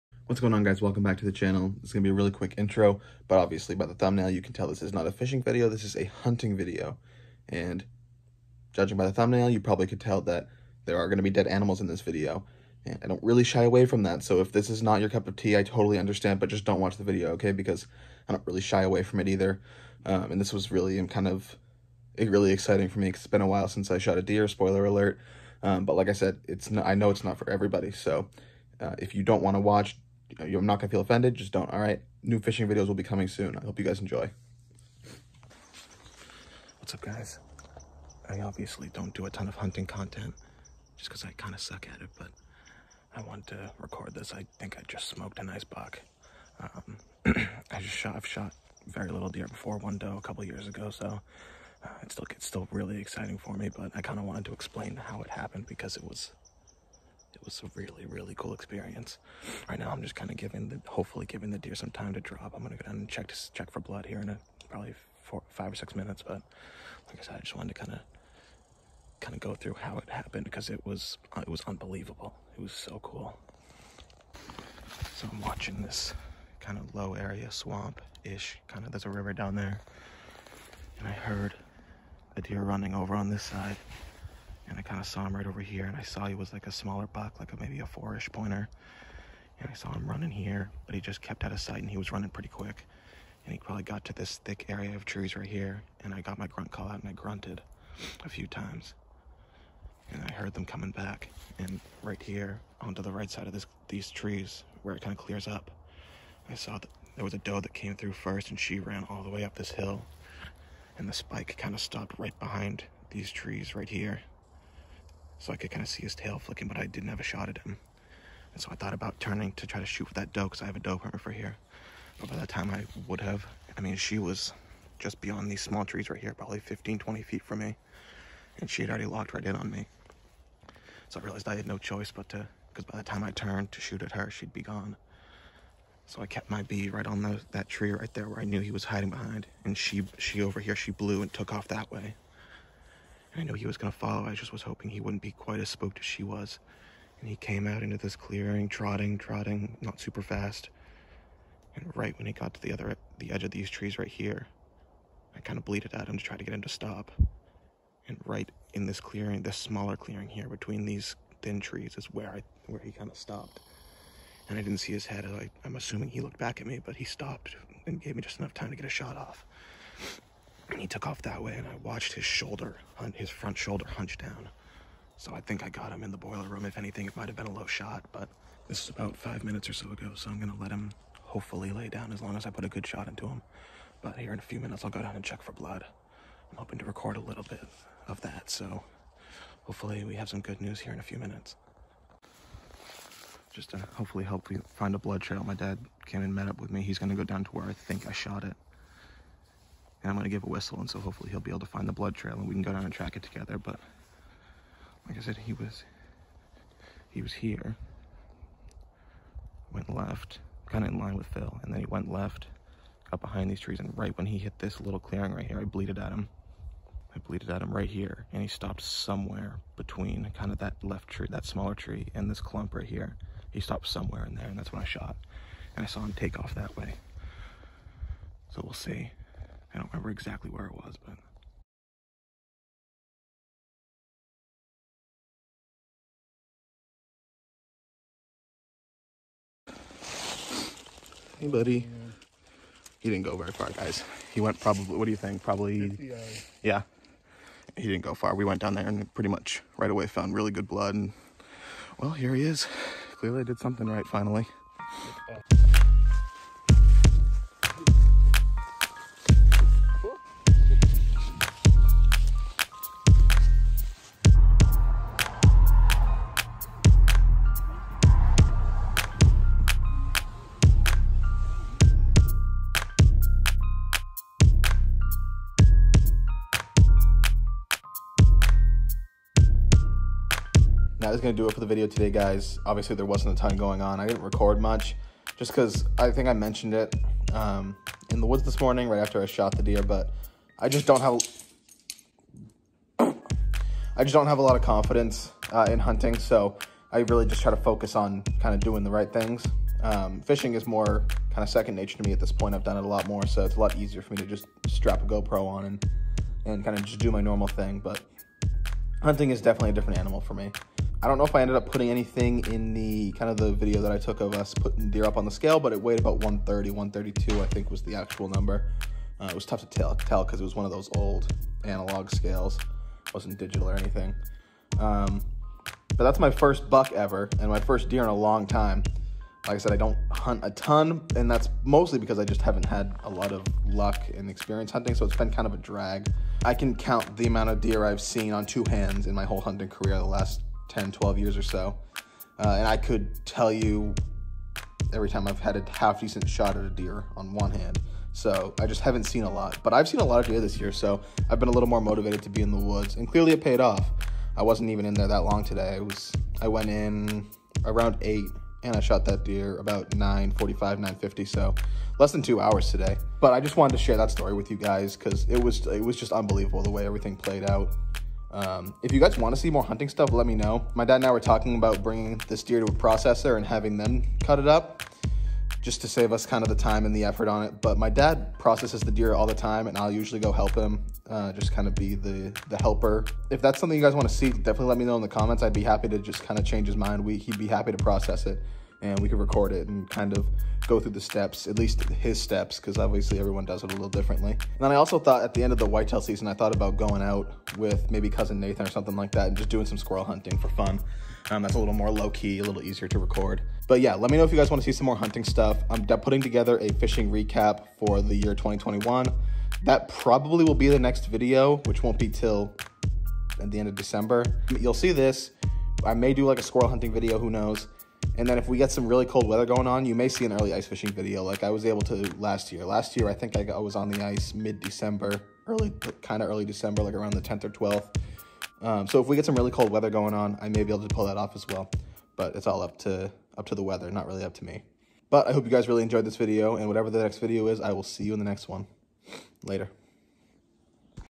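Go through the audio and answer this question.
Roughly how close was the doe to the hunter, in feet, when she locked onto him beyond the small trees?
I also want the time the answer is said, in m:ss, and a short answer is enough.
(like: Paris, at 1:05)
15 to 20 feet, at 2:06.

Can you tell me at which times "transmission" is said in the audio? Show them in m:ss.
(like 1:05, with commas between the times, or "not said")
not said.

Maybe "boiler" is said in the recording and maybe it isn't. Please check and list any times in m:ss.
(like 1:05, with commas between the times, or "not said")
2:56.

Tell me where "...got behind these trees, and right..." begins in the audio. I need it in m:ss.
3:33.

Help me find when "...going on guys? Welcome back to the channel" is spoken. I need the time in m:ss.
0:00.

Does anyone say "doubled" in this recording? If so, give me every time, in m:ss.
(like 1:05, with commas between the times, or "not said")
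not said.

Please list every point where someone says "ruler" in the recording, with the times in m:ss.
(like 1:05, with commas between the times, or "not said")
not said.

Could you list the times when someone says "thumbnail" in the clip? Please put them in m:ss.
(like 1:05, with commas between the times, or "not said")
0:03, 0:09.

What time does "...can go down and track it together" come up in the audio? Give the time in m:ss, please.
3:22.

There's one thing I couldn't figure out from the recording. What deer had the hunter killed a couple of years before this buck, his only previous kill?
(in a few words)
one doe.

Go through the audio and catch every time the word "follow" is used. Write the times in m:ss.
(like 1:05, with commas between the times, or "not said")
2:23.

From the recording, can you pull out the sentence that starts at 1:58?
And so I thought about turning to try to shoot with that doe because I have a doe permit for here.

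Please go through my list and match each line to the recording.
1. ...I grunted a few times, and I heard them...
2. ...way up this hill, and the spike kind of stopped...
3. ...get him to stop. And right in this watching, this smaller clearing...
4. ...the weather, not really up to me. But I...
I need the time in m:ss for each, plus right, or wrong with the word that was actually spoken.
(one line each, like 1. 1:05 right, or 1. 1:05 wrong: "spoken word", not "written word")
1. 1:37 right
2. 1:49 right
3. 2:36 wrong: "clearing", not "watching"
4. 7:13 right.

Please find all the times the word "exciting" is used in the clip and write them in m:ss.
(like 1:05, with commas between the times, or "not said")
0:22, 0:53.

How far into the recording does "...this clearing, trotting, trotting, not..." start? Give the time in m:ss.
2:27.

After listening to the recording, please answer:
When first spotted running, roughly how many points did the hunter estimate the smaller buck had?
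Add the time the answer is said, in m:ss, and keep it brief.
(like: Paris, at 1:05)
4, at 1:27.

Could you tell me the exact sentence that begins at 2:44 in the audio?
And I didn't see his head.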